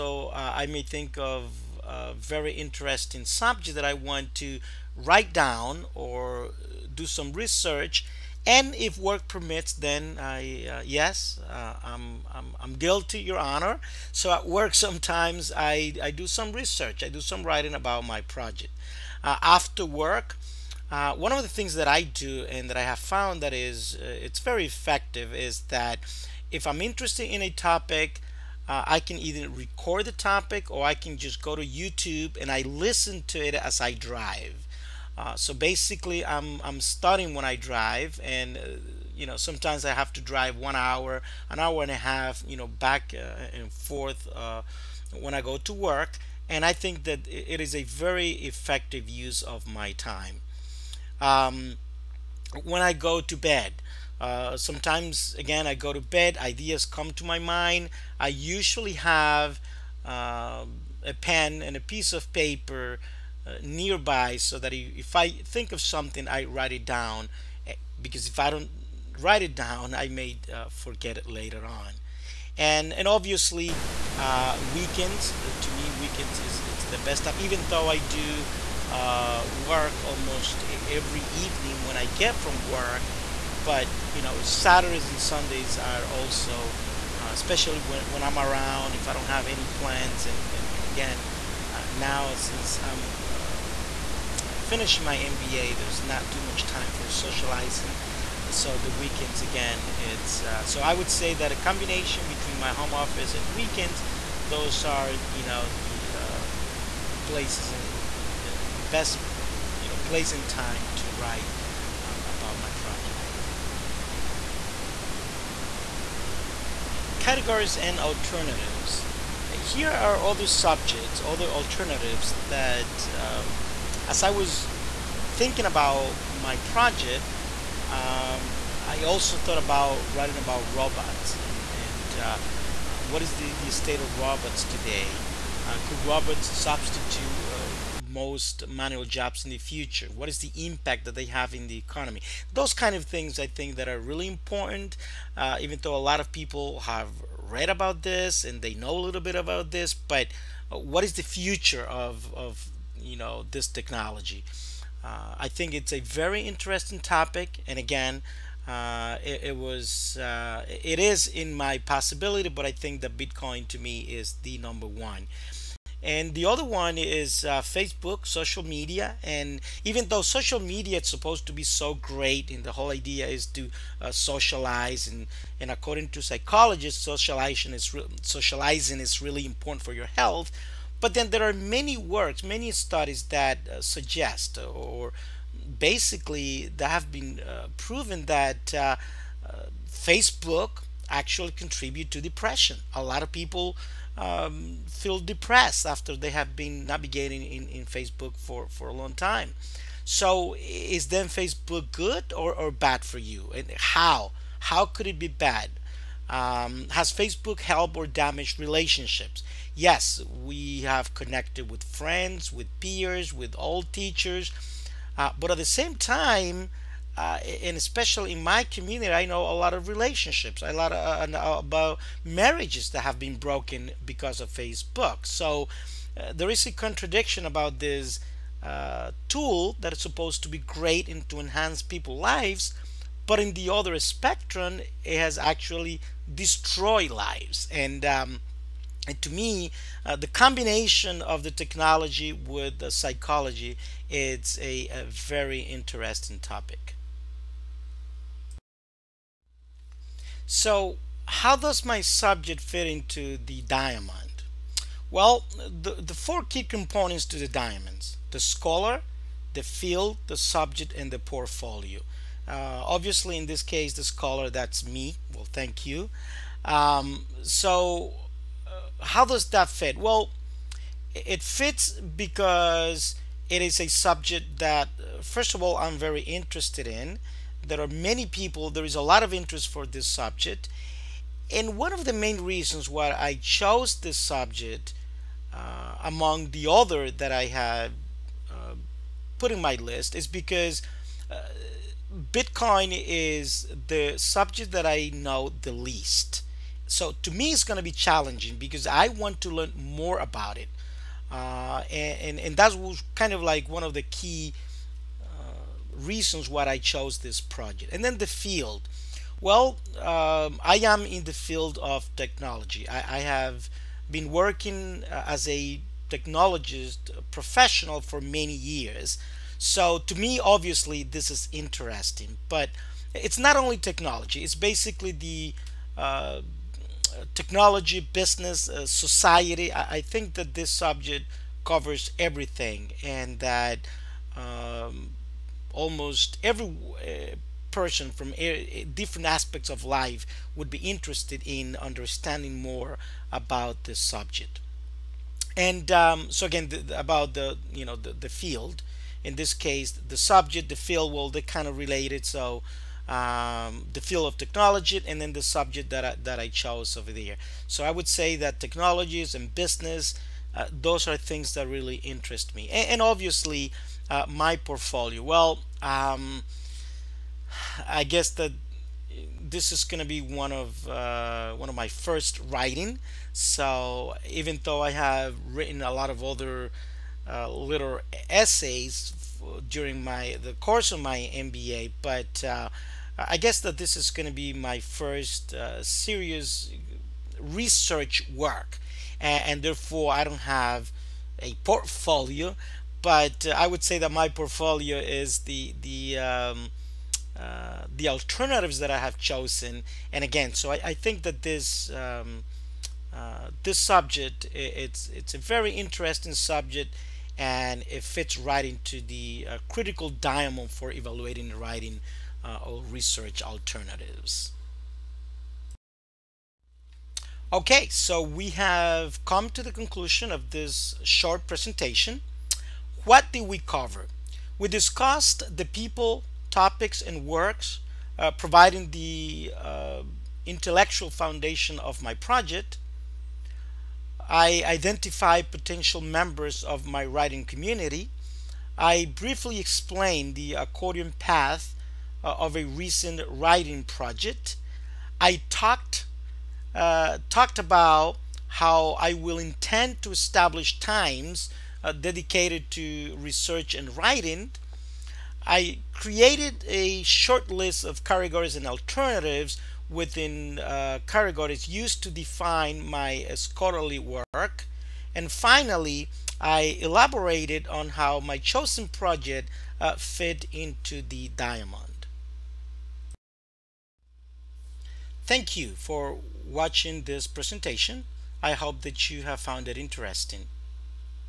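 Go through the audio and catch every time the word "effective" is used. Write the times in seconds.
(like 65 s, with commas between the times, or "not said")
24 s, 48 s.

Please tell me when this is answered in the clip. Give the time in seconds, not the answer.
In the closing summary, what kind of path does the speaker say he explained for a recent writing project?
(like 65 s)
440 s.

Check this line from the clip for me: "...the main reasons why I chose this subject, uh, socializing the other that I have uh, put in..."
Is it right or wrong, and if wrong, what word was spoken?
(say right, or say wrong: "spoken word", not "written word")
wrong: "among", not "socializing".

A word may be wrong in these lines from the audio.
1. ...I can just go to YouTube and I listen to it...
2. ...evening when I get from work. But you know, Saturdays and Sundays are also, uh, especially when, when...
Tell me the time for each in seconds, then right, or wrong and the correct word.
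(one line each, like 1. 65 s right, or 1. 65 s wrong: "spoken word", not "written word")
1. 30 s right
2. 81 s right.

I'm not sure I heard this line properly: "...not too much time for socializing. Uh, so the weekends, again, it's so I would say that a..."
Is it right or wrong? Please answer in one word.
right.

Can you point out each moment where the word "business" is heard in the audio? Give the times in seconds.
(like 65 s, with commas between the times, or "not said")
328 s, 359 s.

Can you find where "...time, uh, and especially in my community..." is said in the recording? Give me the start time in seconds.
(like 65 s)
215 s.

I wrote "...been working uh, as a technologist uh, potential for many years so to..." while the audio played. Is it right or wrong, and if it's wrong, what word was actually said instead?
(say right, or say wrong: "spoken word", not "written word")
wrong: "professional", not "potential".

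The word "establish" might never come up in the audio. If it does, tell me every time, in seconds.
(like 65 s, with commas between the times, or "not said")
450 s.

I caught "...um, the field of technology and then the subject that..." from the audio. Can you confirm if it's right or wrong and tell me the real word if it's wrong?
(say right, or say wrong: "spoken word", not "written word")
right.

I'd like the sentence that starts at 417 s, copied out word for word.
Okay, so we have come to the conclusion of this short presentation.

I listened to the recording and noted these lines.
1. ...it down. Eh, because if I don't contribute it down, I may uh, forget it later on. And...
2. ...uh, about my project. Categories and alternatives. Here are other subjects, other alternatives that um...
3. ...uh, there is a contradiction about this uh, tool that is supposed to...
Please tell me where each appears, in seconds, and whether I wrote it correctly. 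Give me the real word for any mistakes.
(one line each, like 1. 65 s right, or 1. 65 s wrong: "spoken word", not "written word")
1. 66 s wrong: "write", not "contribute"
2. 112 s right
3. 226 s right.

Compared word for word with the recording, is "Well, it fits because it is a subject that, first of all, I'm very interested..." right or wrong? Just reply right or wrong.
right.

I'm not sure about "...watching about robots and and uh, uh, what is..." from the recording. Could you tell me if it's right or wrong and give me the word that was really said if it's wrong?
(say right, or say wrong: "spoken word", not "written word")
wrong: "writing", not "watching".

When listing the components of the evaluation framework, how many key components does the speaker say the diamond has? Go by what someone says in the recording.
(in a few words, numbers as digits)
4.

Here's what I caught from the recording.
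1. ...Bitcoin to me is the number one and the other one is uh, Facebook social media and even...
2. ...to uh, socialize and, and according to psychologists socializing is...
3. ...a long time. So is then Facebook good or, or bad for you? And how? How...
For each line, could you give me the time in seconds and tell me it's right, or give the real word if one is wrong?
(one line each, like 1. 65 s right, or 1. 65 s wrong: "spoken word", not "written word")
1. 163 s right
2. 173 s right
3. 198 s right.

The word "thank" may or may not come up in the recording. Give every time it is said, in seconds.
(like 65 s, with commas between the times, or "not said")
265 s, 475 s.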